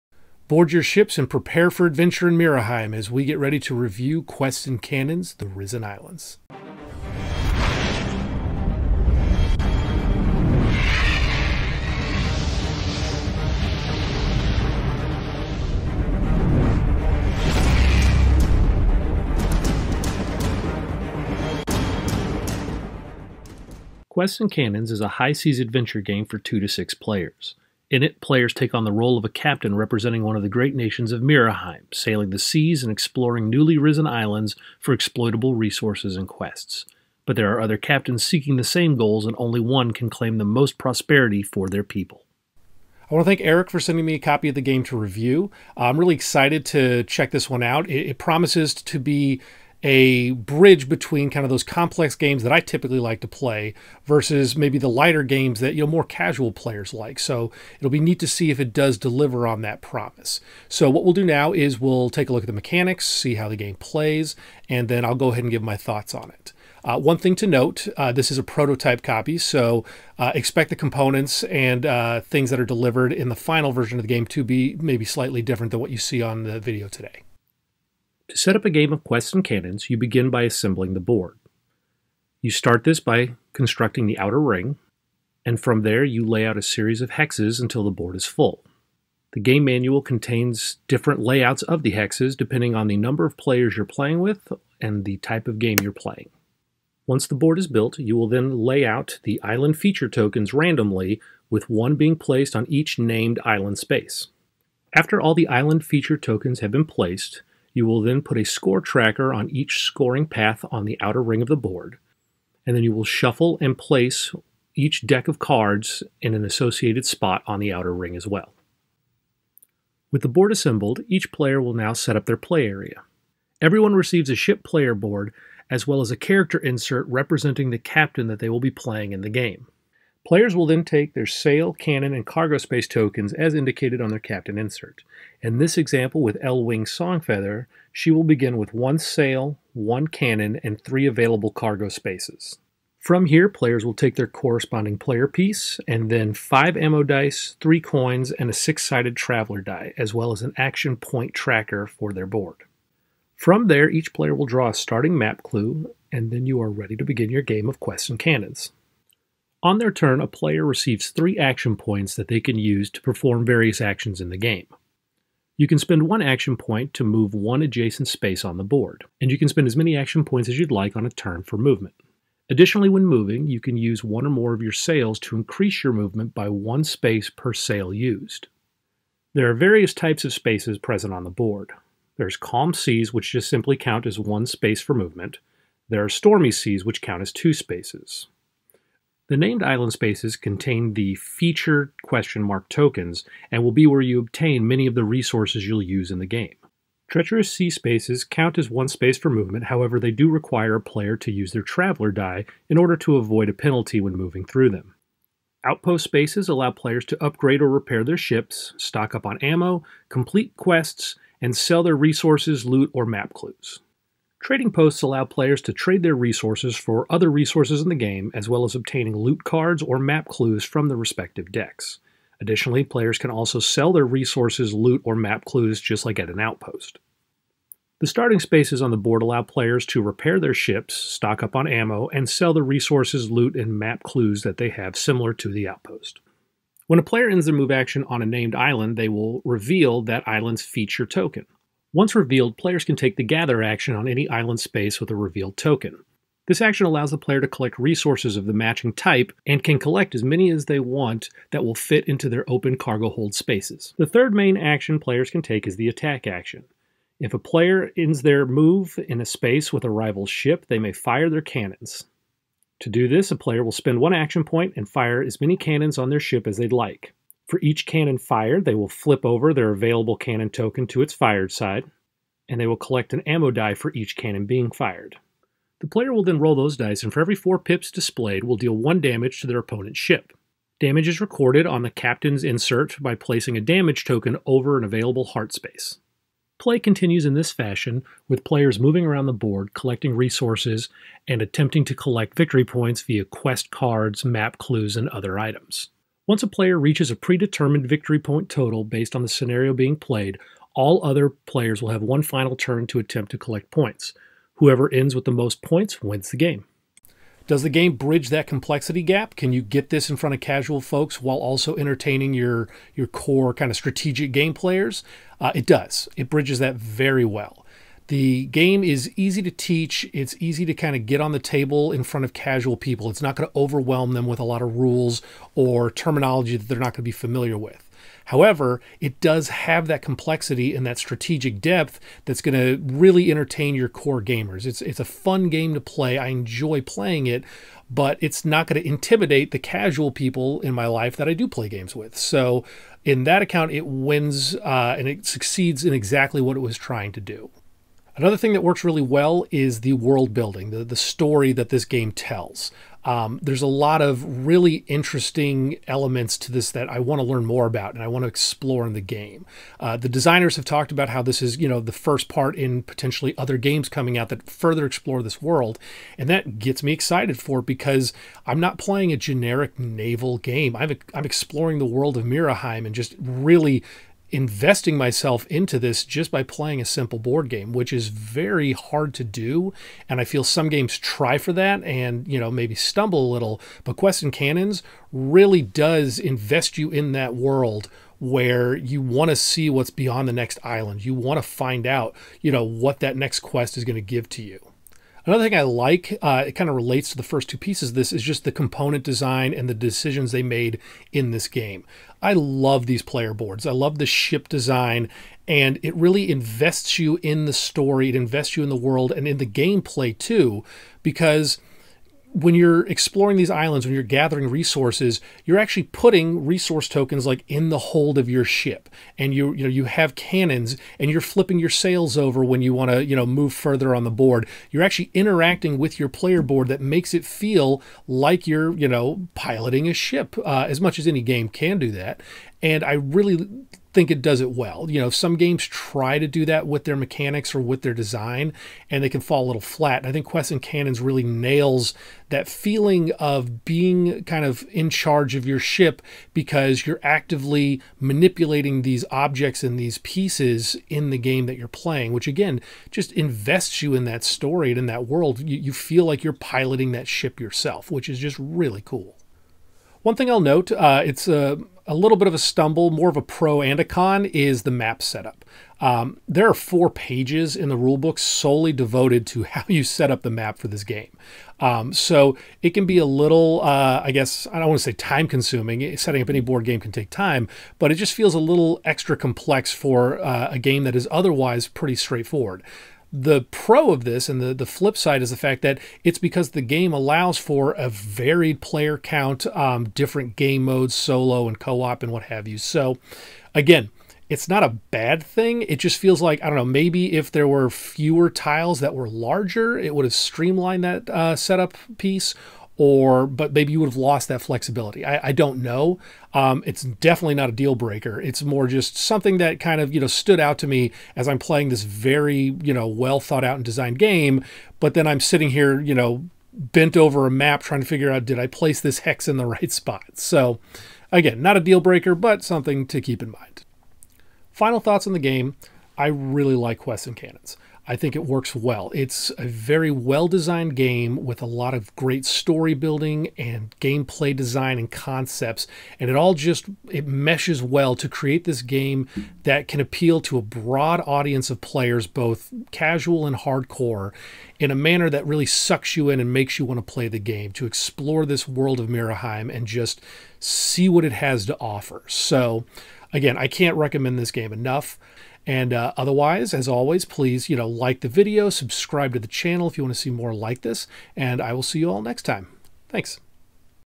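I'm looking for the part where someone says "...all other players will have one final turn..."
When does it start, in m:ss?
5:00.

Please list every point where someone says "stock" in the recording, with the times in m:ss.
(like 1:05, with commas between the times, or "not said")
3:28, 3:50.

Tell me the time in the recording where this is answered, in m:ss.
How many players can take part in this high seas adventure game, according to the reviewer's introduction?
0:26.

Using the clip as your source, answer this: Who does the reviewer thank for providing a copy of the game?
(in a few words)
Eric.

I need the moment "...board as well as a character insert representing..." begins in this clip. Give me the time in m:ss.
2:04.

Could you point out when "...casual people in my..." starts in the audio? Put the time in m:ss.
5:39.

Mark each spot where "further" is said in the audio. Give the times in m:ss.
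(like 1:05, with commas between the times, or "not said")
6:04, 7:03.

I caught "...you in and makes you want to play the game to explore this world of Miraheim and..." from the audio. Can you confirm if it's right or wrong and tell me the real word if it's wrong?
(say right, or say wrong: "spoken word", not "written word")
right.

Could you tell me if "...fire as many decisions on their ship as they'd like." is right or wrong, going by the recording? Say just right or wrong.
wrong.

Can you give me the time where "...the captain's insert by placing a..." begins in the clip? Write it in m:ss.
4:41.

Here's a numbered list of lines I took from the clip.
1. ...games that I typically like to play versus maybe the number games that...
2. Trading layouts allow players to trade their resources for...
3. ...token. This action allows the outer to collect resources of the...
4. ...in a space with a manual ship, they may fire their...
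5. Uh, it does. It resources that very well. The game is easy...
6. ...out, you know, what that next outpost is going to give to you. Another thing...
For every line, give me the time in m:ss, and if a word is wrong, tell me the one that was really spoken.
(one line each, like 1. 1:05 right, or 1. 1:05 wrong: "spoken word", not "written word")
1. 0:52 wrong: "lighter", not "number"
2. 3:34 wrong: "posts", not "layouts"
3. 4:05 wrong: "player", not "outer"
4. 4:19 wrong: "rival", not "manual"
5. 5:15 wrong: "bridges", not "resources"
6. 6:31 wrong: "quest", not "outpost".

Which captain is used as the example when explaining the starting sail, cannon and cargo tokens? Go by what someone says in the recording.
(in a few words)
L-Wing Songfeather.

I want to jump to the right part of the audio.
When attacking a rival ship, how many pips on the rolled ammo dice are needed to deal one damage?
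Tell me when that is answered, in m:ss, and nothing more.
4:37.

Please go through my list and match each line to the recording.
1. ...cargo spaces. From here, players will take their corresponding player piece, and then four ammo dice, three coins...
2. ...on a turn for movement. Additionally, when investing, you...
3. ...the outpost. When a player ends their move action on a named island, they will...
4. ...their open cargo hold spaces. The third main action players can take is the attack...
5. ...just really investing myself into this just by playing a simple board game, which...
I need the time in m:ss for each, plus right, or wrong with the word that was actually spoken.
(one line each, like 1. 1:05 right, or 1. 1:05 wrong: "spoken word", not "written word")
1. 2:21 wrong: "five", not "four"
2. 2:50 wrong: "moving", not "investing"
3. 3:55 right
4. 4:12 right
5. 6:12 right.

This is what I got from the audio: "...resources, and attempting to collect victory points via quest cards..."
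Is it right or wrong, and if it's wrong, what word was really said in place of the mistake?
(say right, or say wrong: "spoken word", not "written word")
right.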